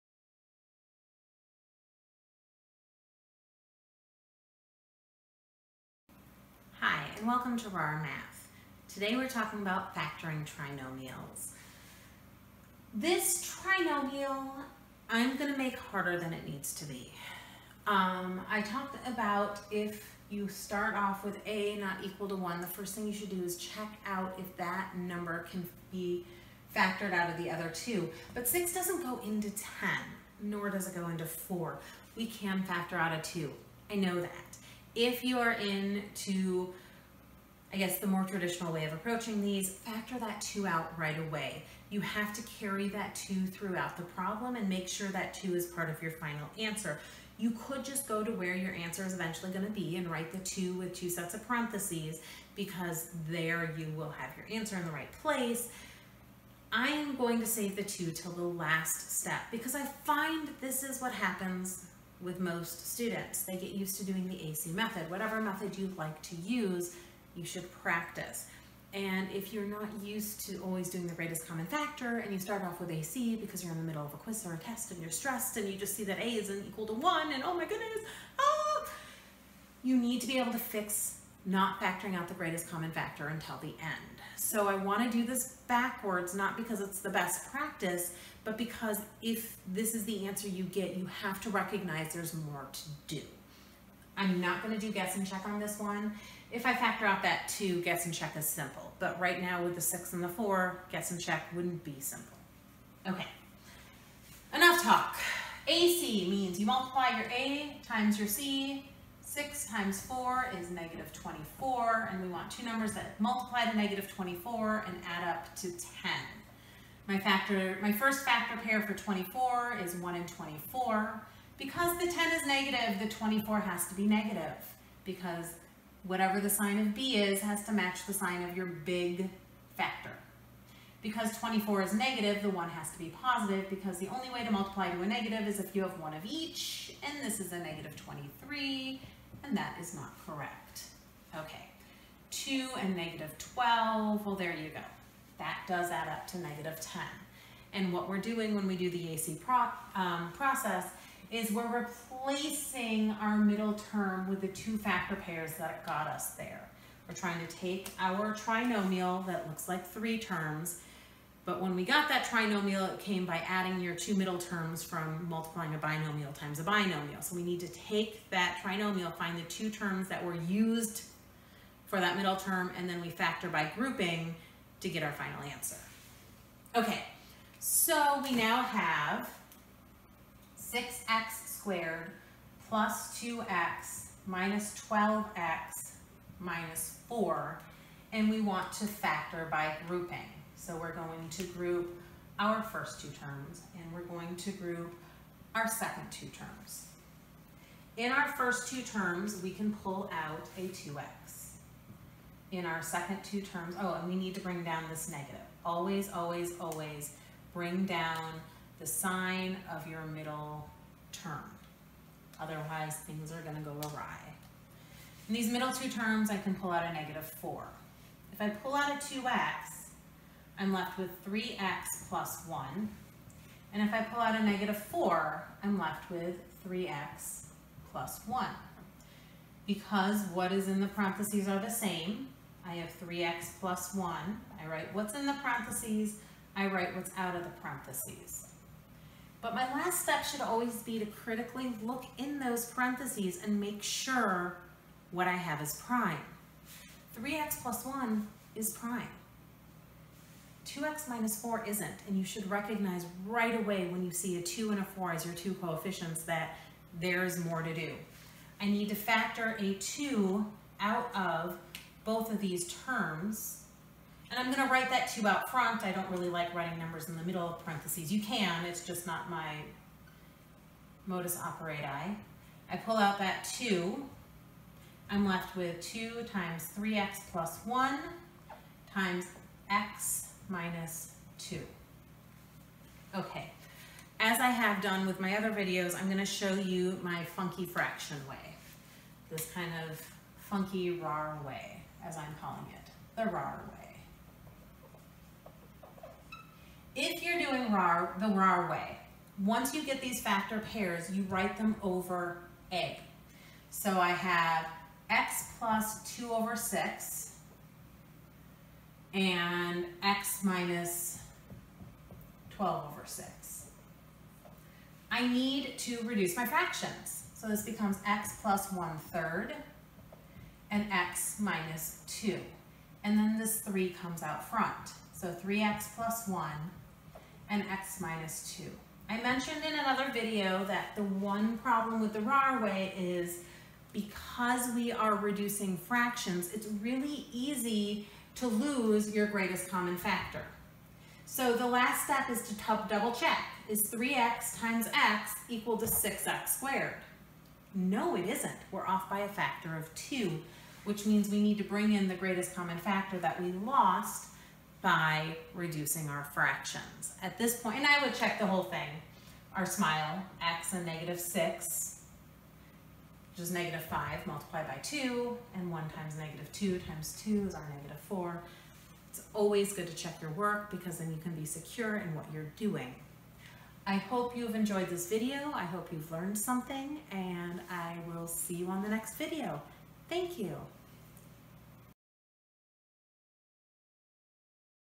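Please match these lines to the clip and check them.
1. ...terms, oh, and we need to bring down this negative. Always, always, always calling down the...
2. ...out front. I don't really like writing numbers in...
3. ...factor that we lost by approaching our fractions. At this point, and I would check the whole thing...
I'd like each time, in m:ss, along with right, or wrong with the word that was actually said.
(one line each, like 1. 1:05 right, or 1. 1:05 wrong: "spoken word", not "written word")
1. 3:23 wrong: "bring", not "calling"
2. 4:25 right
3. 5:52 wrong: "reducing", not "approaching".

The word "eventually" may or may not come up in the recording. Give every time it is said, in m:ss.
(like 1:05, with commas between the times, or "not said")
0:49.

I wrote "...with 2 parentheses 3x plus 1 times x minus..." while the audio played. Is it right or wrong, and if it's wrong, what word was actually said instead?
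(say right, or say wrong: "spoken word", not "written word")
wrong: "times", not "parentheses".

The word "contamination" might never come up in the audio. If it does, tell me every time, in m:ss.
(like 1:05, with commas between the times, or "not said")
not said.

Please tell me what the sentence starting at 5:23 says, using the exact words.
And then this 3 comes out front.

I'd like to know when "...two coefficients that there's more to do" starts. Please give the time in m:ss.
4:15.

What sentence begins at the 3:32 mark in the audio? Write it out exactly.
Otherwise, things are going to go awry.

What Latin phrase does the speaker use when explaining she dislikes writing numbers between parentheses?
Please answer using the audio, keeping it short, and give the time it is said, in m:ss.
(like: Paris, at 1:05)
modus operandi, at 4:31.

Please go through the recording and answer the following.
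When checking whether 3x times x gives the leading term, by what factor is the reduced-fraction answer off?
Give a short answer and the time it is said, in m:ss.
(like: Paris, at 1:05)
2, at 5:49.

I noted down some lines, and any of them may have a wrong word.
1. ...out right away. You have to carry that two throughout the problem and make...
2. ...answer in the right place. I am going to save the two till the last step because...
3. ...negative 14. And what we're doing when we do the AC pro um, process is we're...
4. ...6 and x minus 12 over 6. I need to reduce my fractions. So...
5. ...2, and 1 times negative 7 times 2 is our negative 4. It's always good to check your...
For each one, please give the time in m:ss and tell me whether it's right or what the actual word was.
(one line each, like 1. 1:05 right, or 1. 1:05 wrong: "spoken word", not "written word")
1. 0:40 right
2. 0:54 right
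3. 2:26 wrong: "10", not "14"
4. 5:06 right
5. 6:04 wrong: "2", not "7".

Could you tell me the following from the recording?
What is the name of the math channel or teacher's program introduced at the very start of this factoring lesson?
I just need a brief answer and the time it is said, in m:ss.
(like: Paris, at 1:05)
Rahr Math, at 0:07.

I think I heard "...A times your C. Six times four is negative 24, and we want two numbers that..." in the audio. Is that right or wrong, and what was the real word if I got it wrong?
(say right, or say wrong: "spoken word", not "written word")
right.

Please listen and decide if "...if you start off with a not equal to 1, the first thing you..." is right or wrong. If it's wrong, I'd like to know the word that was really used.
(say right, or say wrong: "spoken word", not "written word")
right.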